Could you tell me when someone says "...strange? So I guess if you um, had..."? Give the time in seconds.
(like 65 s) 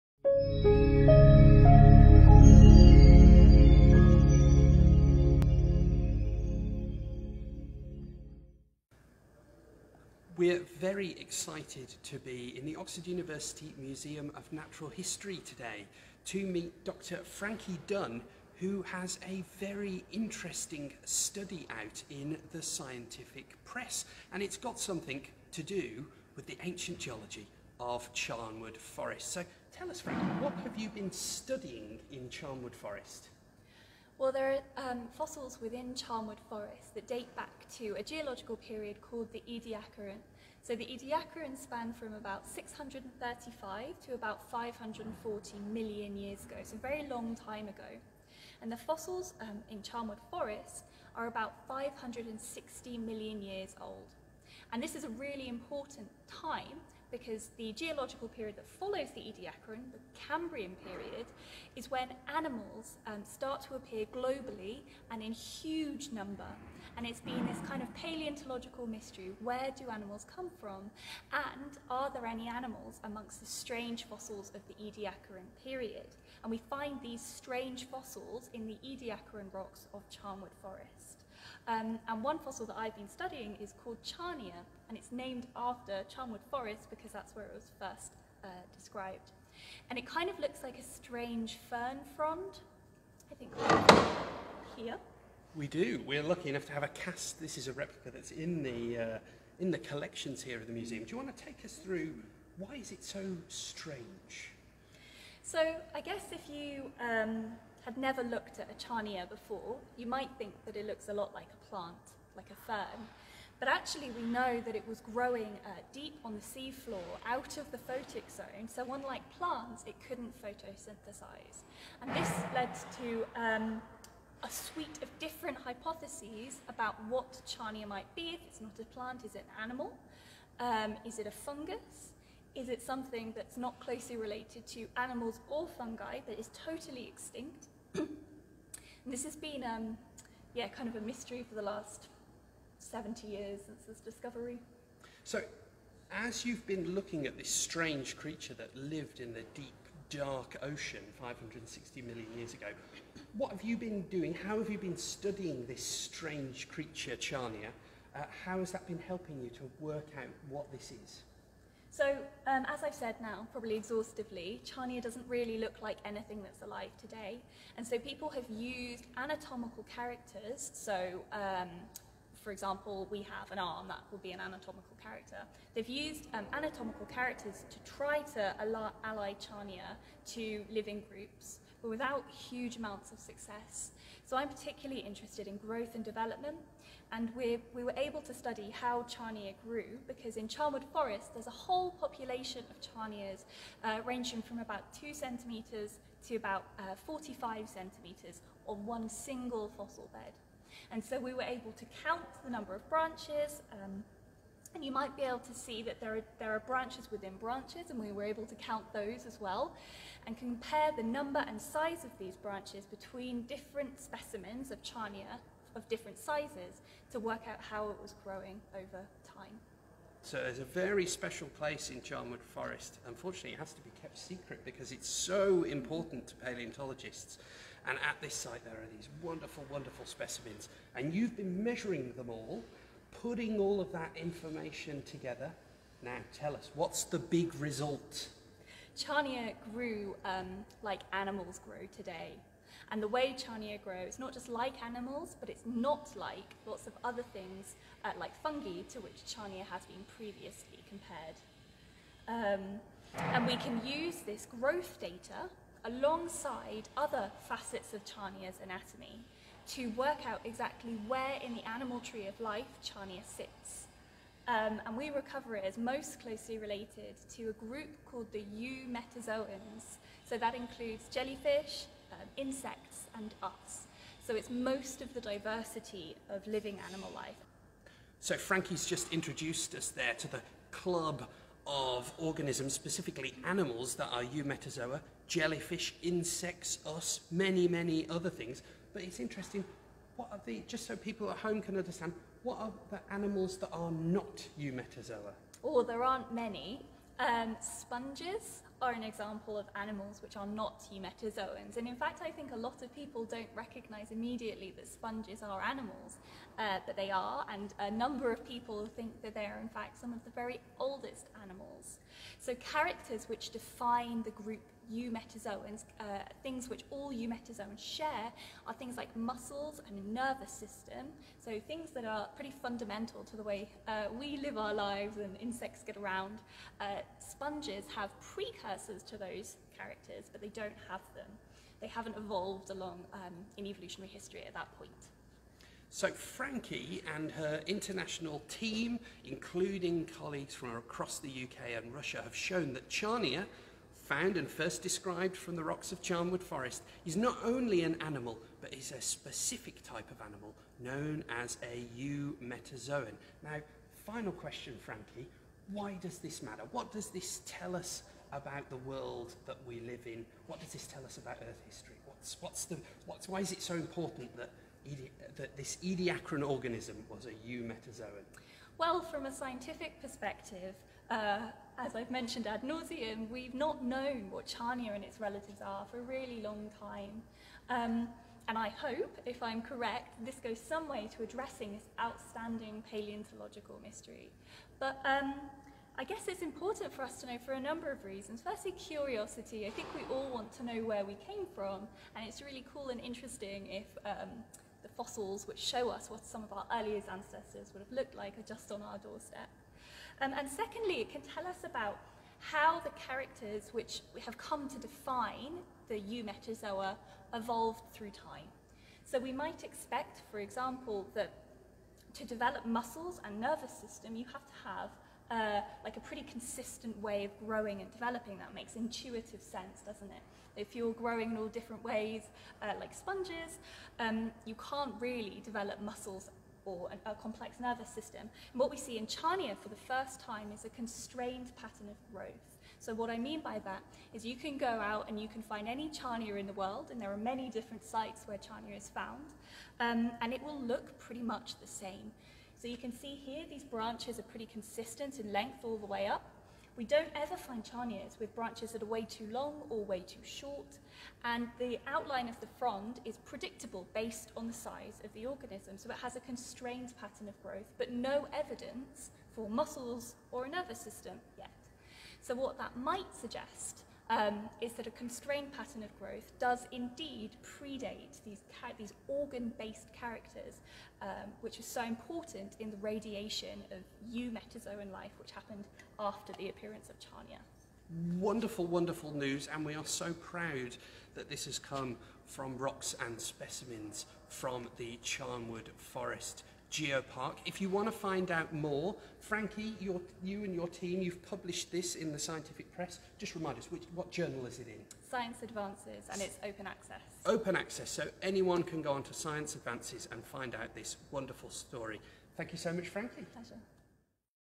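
103 s.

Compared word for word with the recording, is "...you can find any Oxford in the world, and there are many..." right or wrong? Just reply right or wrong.
wrong.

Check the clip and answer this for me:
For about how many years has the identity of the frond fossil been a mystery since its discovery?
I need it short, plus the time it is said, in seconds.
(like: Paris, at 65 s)
70 years, at 142 s.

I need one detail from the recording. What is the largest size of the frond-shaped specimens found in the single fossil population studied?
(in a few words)
45 centimetres.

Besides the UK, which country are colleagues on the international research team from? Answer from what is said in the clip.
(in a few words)
Russia.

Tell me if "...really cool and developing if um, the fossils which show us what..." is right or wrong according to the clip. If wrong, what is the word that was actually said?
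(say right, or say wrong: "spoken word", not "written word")
wrong: "interesting", not "developing".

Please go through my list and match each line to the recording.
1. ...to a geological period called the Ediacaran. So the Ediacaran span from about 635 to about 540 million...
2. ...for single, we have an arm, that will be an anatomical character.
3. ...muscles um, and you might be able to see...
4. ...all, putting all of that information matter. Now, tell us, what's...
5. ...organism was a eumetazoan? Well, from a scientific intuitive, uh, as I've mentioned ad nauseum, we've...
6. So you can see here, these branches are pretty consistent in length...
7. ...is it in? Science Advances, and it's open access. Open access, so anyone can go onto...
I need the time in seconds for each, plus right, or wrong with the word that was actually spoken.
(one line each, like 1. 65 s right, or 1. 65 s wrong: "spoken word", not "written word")
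1. 37 s right
2. 172 s wrong: "example", not "single"
3. 202 s wrong: "branches", not "muscles"
4. 232 s wrong: "together", not "matter"
5. 366 s wrong: "perspective", not "intuitive"
6. 442 s right
7. 494 s right.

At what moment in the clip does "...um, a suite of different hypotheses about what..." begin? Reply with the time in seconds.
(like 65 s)
123 s.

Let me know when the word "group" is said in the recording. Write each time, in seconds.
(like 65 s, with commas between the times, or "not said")
181 s, 267 s, 314 s.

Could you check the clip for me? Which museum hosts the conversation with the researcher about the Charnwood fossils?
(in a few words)
Oxford University Museum of Natural History.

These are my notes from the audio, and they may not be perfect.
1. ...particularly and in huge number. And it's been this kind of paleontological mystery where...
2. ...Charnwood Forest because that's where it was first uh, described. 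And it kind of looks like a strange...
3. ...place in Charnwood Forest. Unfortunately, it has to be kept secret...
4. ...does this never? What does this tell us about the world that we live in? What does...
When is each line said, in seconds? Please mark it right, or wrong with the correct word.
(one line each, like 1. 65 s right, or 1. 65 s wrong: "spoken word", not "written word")
1. 64 s wrong: "globally", not "particularly"
2. 86 s right
3. 221 s right
4. 356 s wrong: "matter", not "never".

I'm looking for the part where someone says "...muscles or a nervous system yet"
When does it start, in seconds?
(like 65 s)
459 s.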